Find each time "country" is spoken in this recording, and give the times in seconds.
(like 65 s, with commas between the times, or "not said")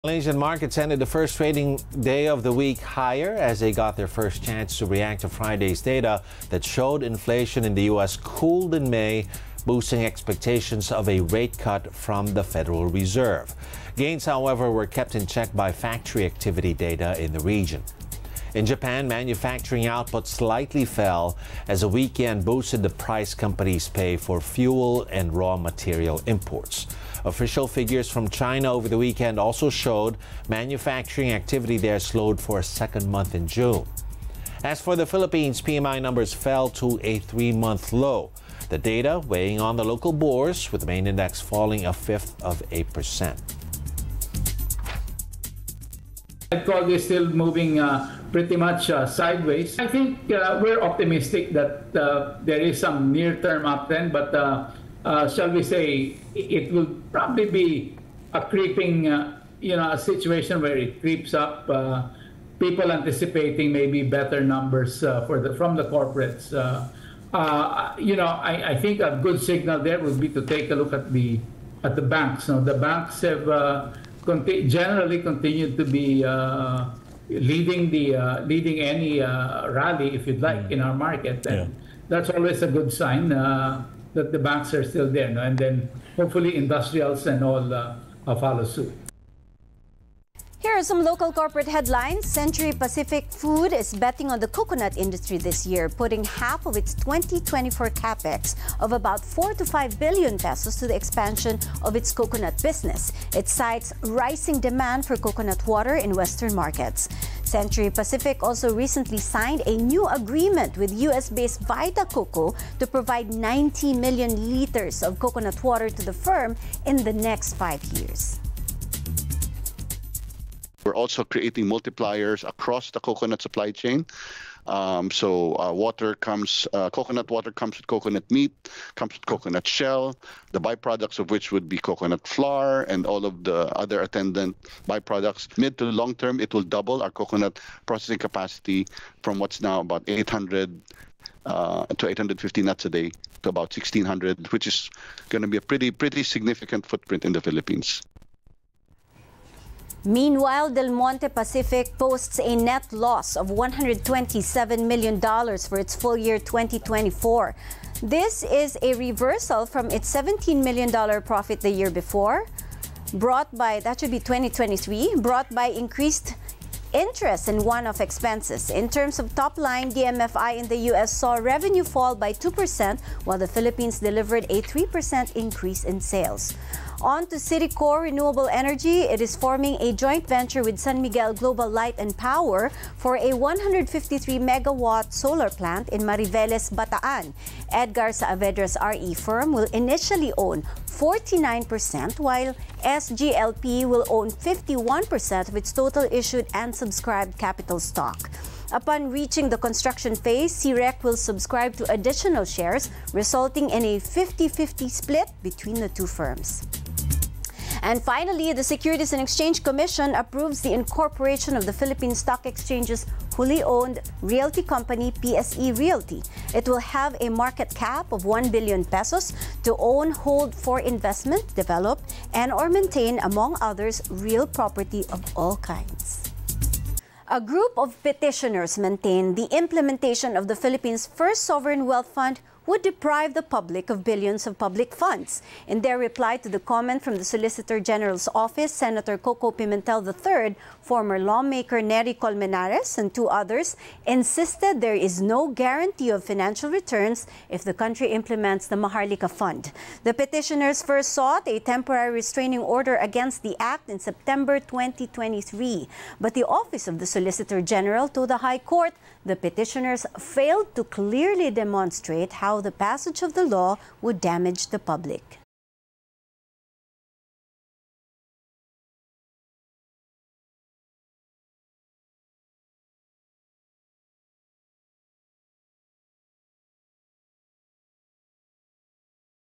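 247 s.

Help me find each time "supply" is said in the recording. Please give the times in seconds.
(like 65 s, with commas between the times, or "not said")
123 s.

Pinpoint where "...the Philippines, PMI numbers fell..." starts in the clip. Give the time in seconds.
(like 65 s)
34 s.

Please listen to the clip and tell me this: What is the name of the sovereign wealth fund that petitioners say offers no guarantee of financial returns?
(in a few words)
Maharlika Fund.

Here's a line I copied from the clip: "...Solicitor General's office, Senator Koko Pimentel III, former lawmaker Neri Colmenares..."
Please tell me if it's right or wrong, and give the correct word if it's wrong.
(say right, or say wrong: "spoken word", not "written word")
right.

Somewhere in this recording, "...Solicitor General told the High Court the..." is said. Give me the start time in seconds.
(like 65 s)
257 s.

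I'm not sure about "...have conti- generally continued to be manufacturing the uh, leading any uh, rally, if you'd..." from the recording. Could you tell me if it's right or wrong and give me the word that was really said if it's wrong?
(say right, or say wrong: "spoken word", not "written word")
wrong: "leading", not "manufacturing".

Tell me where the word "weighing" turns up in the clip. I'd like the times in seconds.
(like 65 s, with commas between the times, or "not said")
39 s.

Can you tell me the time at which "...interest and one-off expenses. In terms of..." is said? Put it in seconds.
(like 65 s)
166 s.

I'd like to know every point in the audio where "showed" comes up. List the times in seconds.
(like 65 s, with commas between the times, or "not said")
6 s, 29 s.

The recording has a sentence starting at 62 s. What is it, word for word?
people anticipating maybe better numbers for the from the corporates.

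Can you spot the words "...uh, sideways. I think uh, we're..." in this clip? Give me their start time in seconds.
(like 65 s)
48 s.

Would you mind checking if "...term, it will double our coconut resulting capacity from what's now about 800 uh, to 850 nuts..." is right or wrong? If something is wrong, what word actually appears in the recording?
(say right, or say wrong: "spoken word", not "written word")
wrong: "processing", not "resulting".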